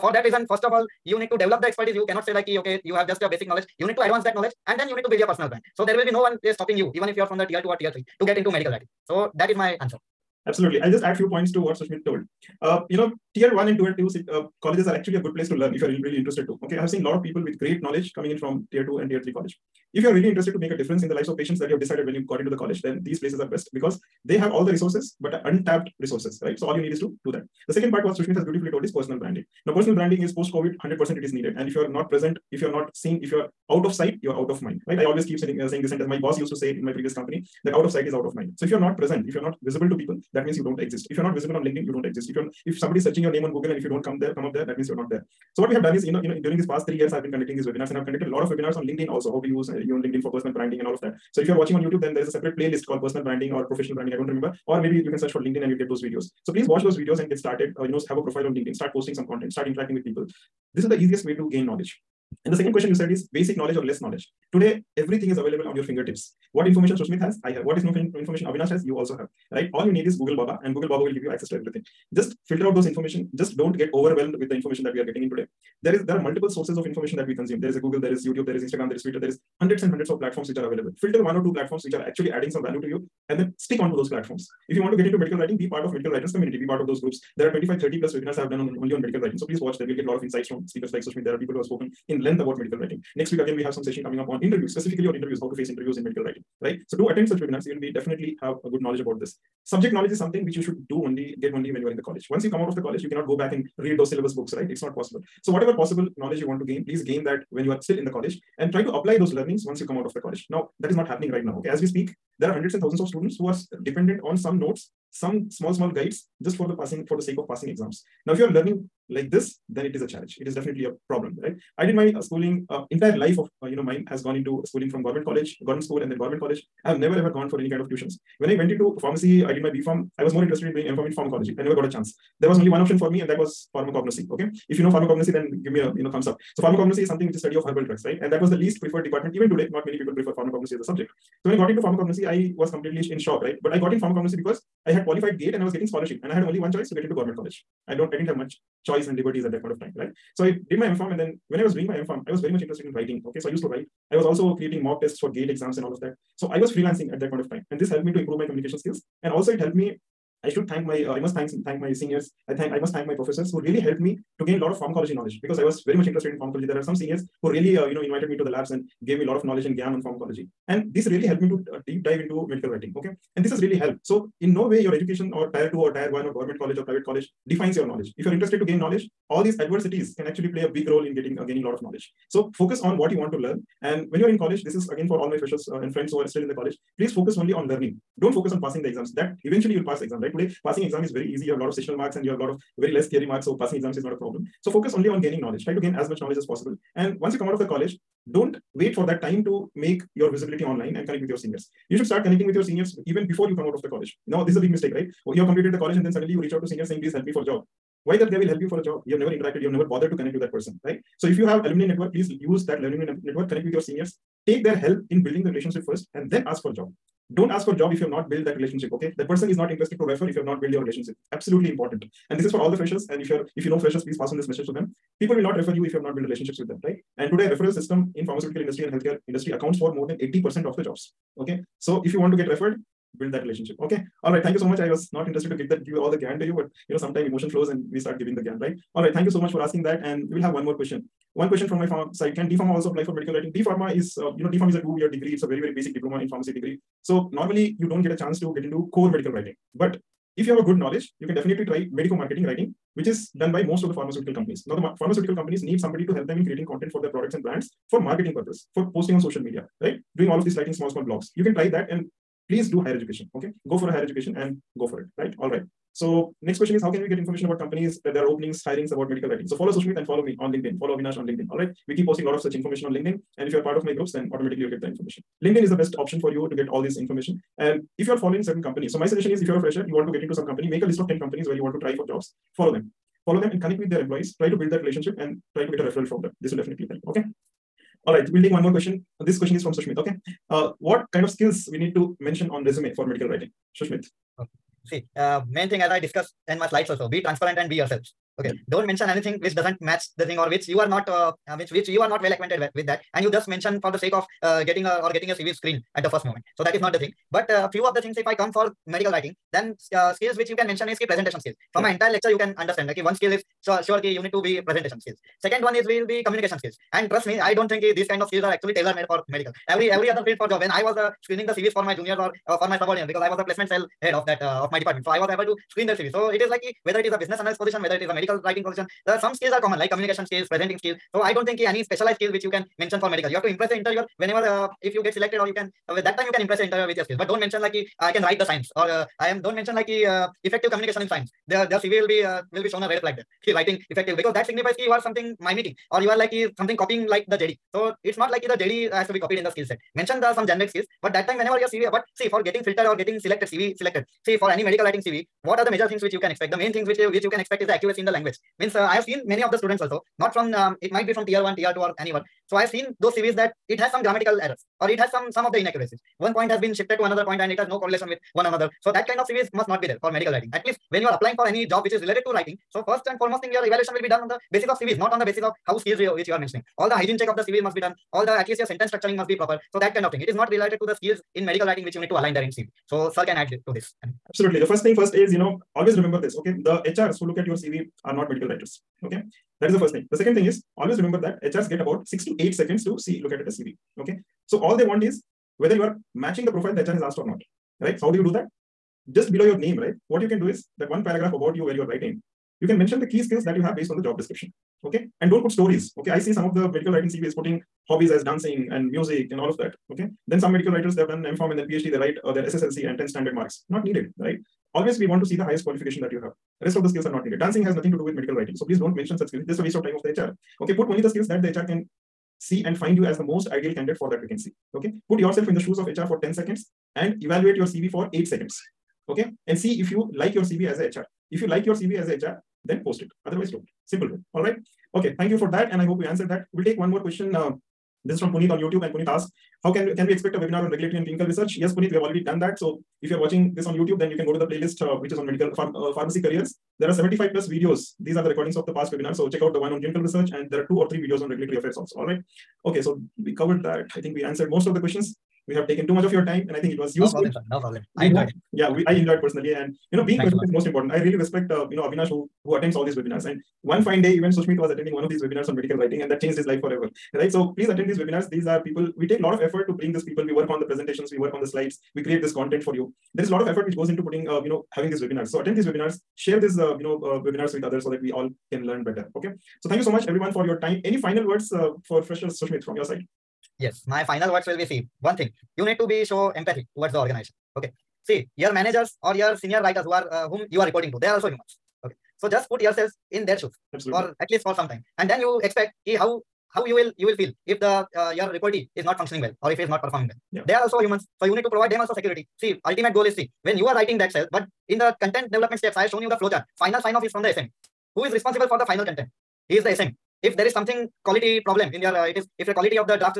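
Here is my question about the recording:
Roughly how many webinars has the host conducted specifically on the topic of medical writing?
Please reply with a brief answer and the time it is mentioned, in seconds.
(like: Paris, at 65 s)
25 30 plus, at 87 s.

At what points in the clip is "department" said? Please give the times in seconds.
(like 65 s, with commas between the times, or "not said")
139 s, 324 s.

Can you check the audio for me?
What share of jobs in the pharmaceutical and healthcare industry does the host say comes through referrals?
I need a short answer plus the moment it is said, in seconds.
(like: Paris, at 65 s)
more than 80%, at 229 s.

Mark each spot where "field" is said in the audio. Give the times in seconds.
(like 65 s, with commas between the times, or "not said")
320 s.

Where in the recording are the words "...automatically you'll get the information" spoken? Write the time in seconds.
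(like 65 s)
274 s.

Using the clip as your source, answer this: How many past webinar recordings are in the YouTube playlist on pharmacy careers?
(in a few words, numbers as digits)
75 plus.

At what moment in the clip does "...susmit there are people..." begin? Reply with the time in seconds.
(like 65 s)
91 s.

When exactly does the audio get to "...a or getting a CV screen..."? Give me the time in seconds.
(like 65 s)
304 s.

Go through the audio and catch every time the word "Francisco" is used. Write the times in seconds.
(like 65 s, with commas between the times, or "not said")
not said.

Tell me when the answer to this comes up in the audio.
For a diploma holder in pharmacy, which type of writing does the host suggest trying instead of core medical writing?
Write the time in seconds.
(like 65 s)
251 s.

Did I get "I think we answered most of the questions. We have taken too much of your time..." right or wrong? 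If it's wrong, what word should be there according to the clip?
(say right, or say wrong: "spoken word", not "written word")
right.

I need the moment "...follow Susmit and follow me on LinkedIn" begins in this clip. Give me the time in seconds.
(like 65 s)
269 s.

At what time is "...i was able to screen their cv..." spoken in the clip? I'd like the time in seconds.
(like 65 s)
325 s.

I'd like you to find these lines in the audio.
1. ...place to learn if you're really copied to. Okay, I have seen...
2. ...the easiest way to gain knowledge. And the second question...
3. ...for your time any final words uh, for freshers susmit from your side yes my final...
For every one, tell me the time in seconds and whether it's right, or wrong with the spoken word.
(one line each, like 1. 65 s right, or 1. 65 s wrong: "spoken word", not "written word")
1. 15 s wrong: "interested", not "copied"
2. 60 s right
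3. 480 s right.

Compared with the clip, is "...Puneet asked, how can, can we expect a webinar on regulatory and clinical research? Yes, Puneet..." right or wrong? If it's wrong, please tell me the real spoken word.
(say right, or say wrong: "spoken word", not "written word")
right.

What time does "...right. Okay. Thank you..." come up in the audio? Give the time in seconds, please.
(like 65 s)
434 s.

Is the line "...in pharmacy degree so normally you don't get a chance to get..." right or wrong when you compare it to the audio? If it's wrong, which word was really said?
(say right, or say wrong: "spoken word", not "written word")
right.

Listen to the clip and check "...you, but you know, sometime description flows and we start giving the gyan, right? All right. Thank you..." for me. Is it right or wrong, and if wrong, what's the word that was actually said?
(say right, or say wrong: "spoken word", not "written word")
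wrong: "emotion", not "description".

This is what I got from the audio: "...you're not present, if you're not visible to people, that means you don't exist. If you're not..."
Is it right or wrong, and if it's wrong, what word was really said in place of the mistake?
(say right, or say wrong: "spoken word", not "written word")
right.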